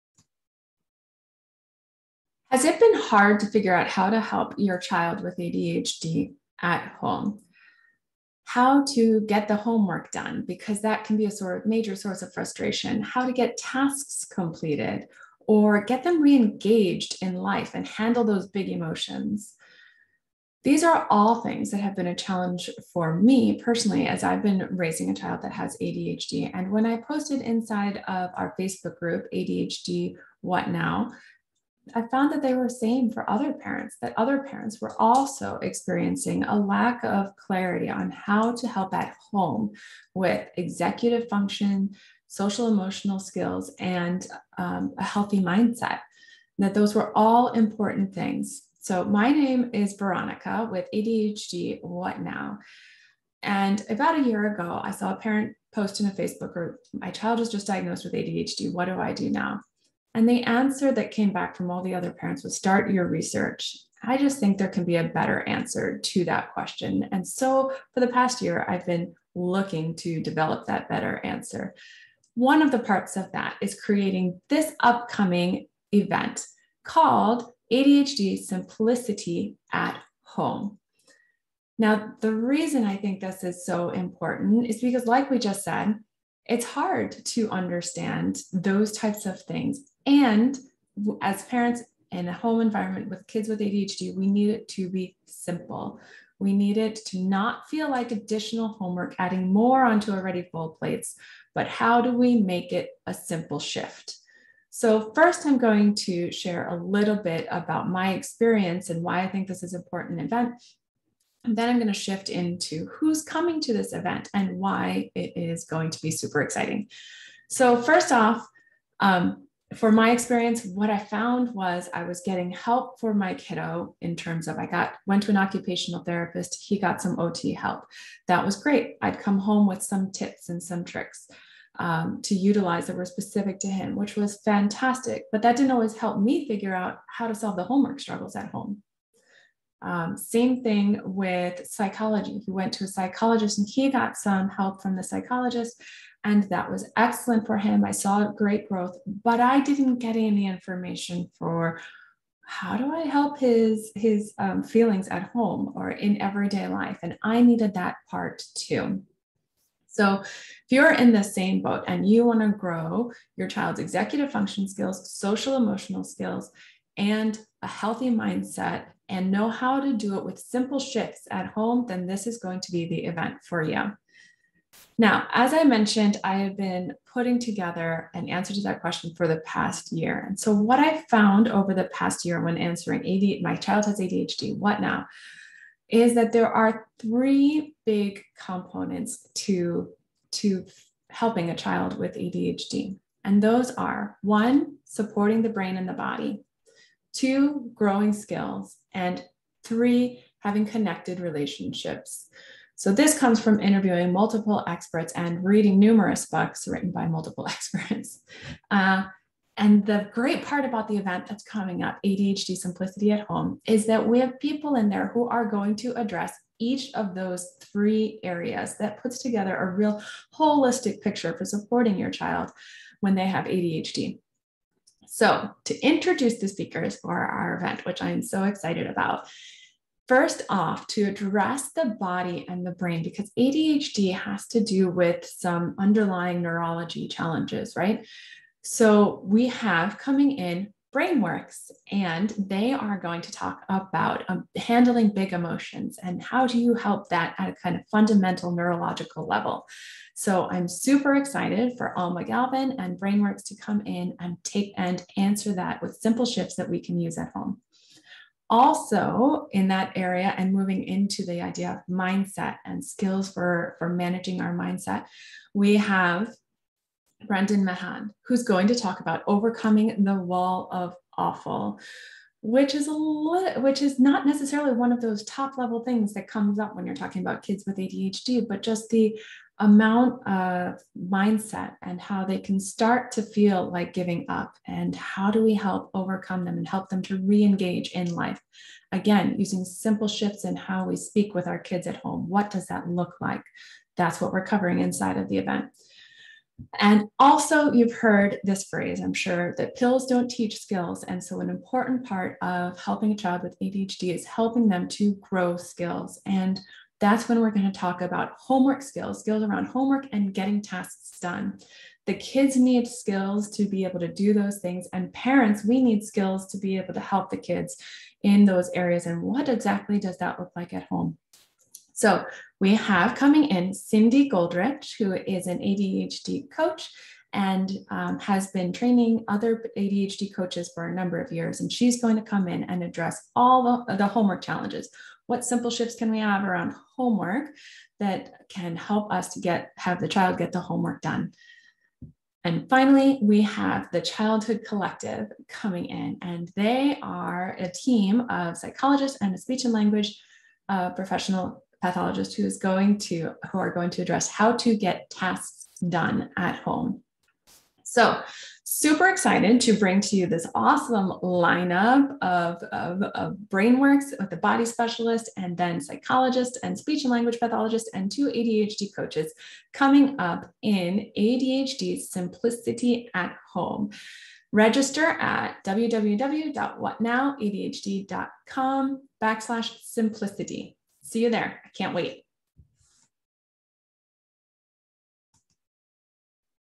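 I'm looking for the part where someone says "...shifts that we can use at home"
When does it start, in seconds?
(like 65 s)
256 s.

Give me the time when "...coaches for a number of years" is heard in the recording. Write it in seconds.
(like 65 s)
330 s.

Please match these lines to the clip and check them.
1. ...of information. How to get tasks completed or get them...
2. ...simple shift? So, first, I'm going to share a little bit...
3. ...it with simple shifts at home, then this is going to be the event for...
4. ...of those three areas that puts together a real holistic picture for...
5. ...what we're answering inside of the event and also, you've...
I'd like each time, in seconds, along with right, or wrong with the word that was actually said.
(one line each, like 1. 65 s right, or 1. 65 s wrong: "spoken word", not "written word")
1. 12 s wrong: "frustration", not "information"
2. 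103 s right
3. 170 s right
4. 216 s right
5. 294 s wrong: "covering", not "answering".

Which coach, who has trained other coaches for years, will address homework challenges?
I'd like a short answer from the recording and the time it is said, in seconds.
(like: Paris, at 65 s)
Cindy Goldrich, at 323 s.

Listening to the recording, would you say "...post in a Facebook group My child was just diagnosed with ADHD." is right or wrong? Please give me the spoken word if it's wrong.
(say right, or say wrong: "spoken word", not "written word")
right.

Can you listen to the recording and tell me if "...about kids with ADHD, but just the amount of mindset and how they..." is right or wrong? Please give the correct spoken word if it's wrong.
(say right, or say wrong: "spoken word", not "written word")
right.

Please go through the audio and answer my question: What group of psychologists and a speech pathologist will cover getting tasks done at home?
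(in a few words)
the Childhood Collective.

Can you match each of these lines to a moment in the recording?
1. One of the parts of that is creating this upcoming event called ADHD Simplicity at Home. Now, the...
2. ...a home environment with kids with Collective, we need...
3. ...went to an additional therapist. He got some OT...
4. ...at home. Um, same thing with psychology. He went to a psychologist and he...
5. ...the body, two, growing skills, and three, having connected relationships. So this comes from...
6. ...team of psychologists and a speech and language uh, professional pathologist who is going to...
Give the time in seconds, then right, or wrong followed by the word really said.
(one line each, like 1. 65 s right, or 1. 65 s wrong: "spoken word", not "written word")
1. 72 s right
2. 92 s wrong: "ADHD", not "Collective"
3. 125 s wrong: "occupational", not "additional"
4. 138 s right
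5. 195 s right
6. 347 s right.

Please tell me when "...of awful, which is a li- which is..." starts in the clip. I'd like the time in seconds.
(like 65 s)
270 s.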